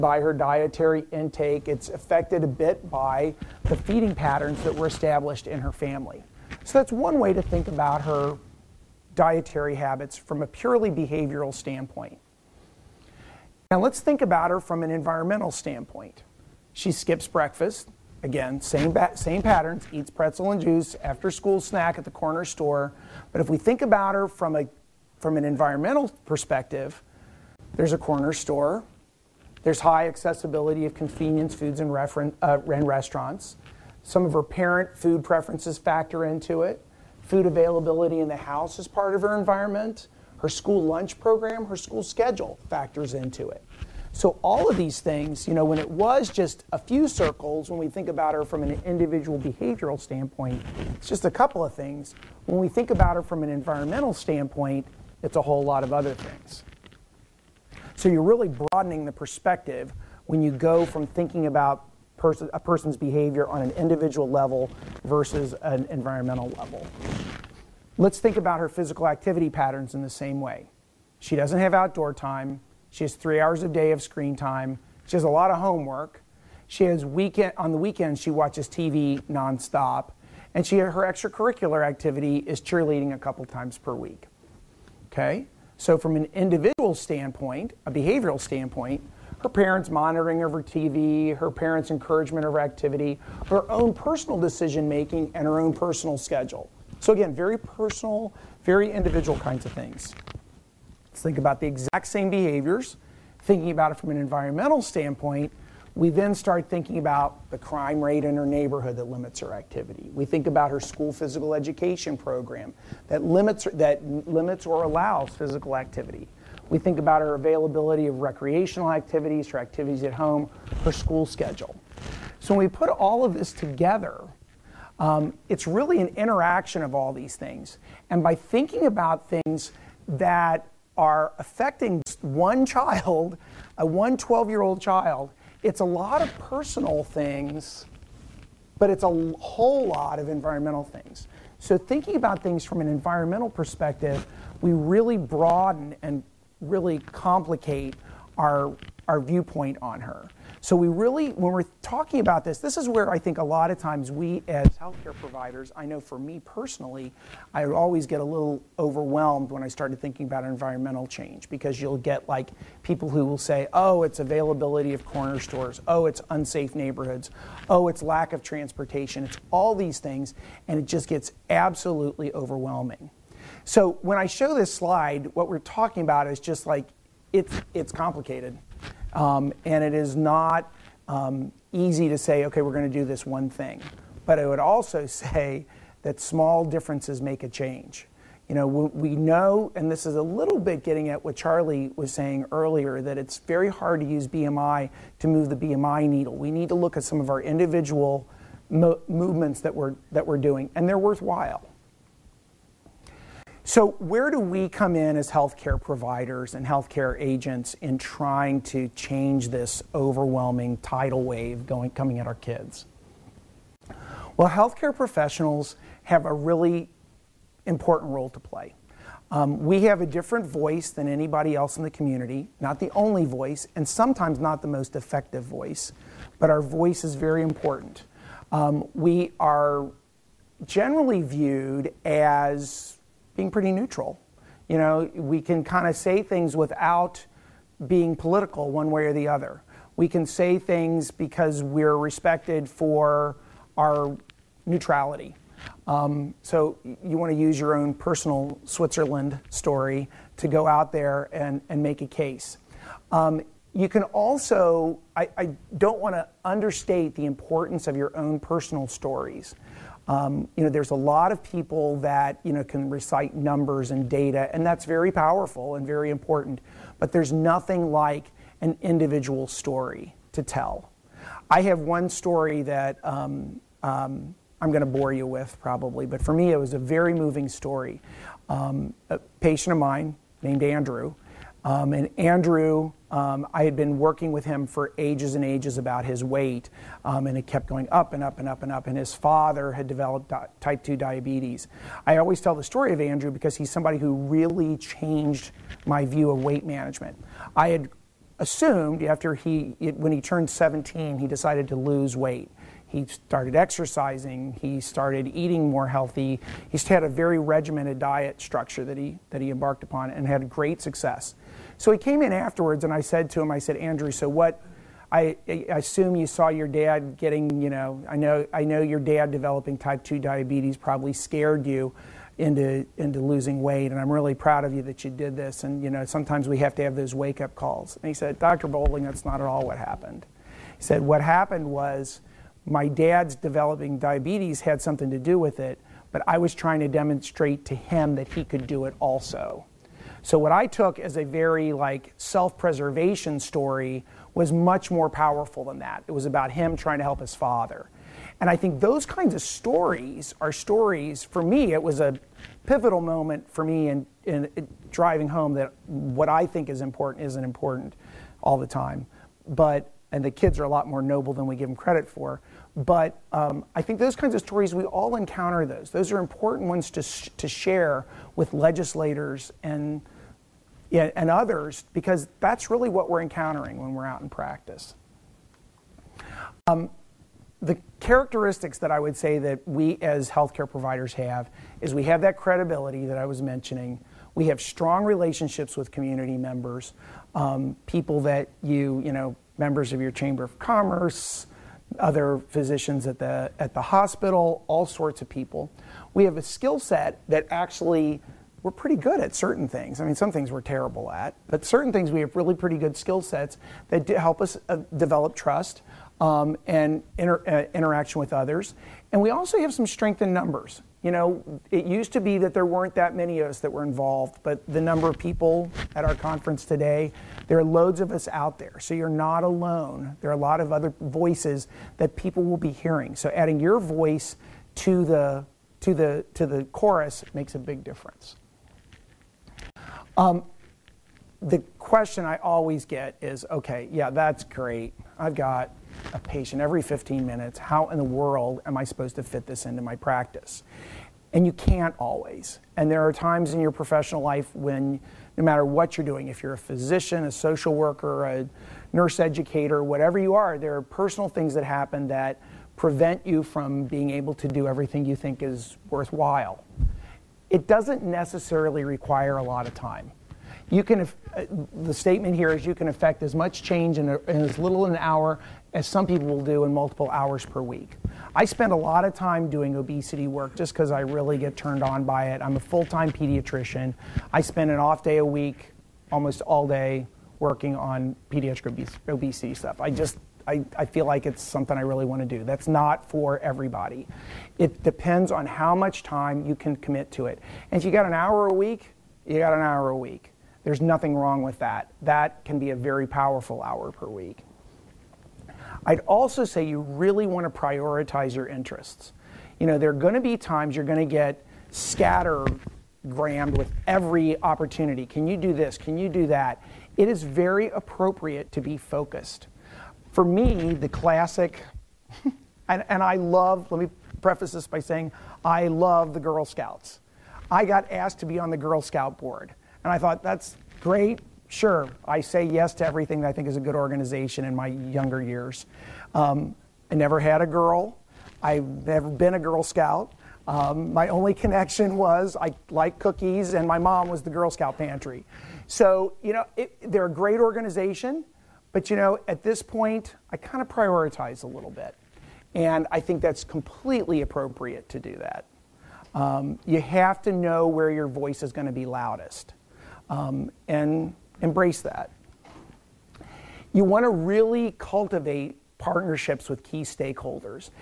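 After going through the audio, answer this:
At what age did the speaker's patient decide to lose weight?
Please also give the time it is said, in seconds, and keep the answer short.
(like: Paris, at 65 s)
17, at 300 s.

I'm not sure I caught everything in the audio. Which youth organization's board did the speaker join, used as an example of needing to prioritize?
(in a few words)
Girl Scouts.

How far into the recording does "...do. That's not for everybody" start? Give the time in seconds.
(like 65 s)
482 s.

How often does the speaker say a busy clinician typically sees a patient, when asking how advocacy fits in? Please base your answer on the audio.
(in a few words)
every 15 minutes.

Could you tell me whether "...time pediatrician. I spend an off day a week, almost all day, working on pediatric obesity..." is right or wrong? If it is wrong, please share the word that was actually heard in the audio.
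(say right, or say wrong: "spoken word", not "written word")
right.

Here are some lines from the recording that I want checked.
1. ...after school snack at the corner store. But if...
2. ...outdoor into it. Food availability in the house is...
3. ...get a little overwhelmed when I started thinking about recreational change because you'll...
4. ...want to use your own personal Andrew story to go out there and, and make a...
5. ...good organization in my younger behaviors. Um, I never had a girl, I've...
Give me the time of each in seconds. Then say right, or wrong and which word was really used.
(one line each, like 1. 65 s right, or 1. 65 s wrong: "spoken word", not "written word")
1. 21 s right
2. 35 s wrong: "factor", not "outdoor"
3. 158 s wrong: "environmental", not "recreational"
4. 247 s wrong: "Switzerland", not "Andrew"
5. 523 s wrong: "years", not "behaviors".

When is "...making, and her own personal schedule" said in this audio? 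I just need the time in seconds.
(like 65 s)
94 s.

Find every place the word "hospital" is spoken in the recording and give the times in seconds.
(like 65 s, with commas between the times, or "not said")
393 s.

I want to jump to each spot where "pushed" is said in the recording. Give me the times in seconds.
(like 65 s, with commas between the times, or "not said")
not said.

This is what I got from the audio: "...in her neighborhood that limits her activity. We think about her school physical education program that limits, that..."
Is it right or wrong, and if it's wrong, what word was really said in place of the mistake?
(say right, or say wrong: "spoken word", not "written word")
right.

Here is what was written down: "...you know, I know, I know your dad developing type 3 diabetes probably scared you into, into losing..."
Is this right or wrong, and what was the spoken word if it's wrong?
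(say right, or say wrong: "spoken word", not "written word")
wrong: "2", not "3".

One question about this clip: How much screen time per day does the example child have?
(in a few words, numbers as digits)
3 hours.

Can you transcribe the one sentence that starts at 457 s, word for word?
It doesn't necessarily require a lot of time.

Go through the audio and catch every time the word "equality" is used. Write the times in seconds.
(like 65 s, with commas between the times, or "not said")
not said.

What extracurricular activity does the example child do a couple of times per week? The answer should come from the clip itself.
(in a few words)
cheerleading.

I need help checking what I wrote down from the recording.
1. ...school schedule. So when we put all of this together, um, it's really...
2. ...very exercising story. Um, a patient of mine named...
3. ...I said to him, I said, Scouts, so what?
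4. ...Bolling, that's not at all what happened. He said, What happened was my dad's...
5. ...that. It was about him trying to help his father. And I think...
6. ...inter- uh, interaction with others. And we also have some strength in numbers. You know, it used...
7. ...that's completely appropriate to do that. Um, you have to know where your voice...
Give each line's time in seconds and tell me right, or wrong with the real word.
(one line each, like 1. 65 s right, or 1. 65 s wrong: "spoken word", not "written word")
1. 120 s right
2. 276 s wrong: "moving", not "exercising"
3. 312 s wrong: "Andrew", not "Scouts"
4. 328 s right
5. 345 s right
6. 407 s right
7. 543 s right.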